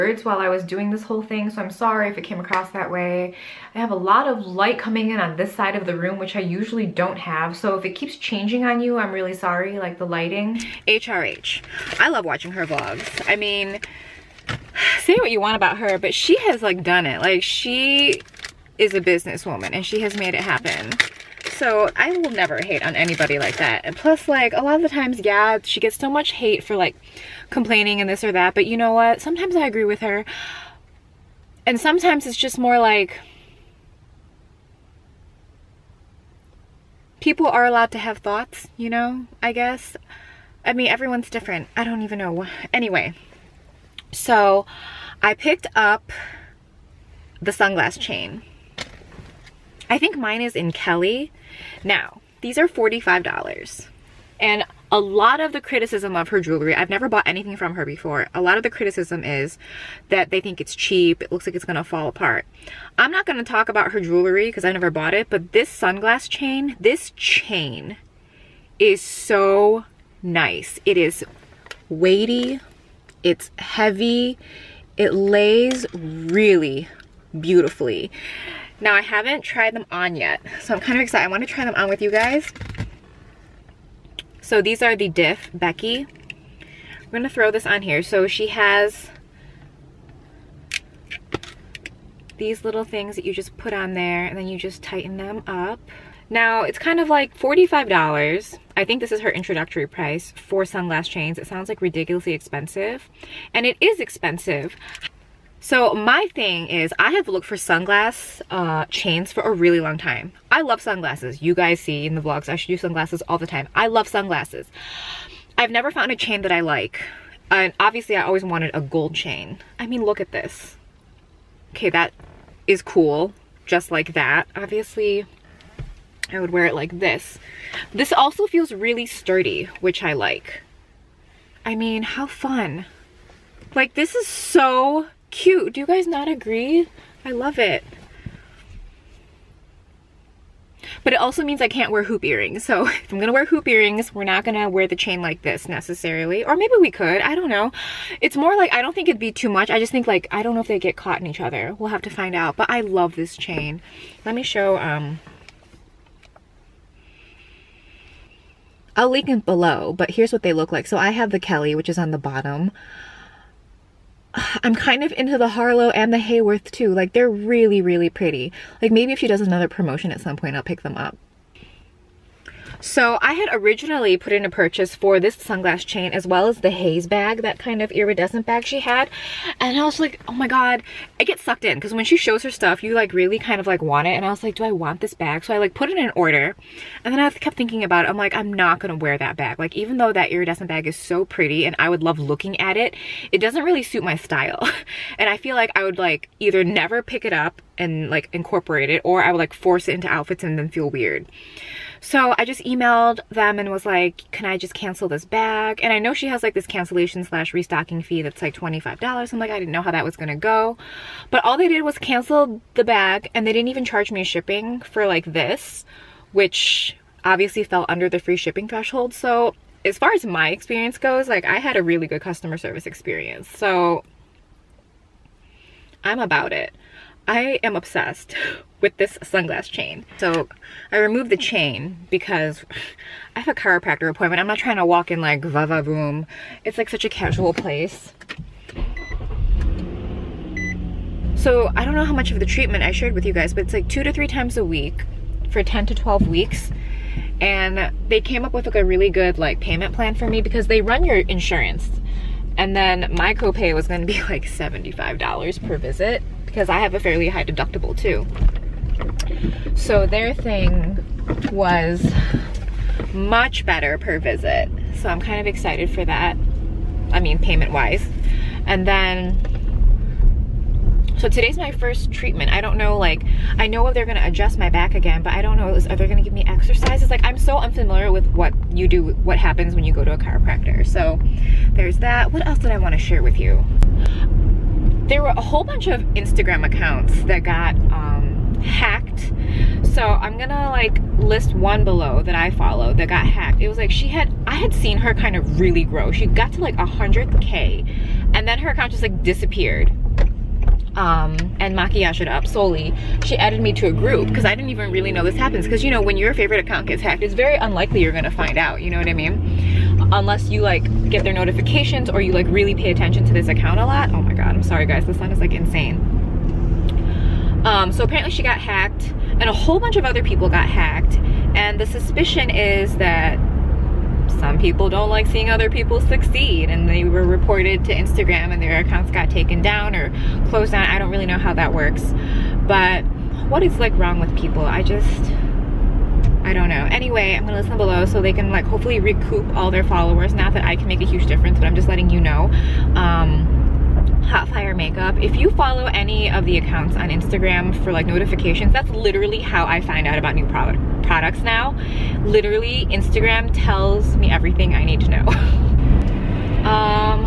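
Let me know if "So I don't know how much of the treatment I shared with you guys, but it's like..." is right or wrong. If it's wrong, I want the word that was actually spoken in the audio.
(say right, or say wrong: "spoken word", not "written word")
right.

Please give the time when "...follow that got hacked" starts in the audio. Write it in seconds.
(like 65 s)
292 s.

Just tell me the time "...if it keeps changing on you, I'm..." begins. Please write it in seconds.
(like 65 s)
7 s.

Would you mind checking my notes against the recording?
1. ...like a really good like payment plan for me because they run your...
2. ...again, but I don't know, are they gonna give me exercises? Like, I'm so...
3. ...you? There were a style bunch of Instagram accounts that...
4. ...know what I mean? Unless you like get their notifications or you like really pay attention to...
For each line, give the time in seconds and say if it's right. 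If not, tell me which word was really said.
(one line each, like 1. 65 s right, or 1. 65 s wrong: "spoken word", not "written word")
1. 248 s right
2. 274 s right
3. 283 s wrong: "whole", not "style"
4. 308 s right.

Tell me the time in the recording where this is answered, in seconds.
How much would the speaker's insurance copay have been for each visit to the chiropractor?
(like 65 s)
254 s.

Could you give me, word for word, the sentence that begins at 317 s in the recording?
Um, so apparently she got hacked and a whole bunch of other people got hacked.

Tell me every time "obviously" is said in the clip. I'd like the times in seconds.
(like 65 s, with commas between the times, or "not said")
117 s, 124 s, 217 s.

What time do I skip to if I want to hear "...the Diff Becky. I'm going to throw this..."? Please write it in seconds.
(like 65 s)
84 s.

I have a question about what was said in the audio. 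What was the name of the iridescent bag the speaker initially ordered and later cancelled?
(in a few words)
haze bag.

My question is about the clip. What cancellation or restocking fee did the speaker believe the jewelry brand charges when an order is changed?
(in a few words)
$25.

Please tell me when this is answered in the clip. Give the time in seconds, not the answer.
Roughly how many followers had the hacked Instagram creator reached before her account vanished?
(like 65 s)
296 s.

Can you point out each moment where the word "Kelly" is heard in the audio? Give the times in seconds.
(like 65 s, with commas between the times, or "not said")
50 s, 161 s.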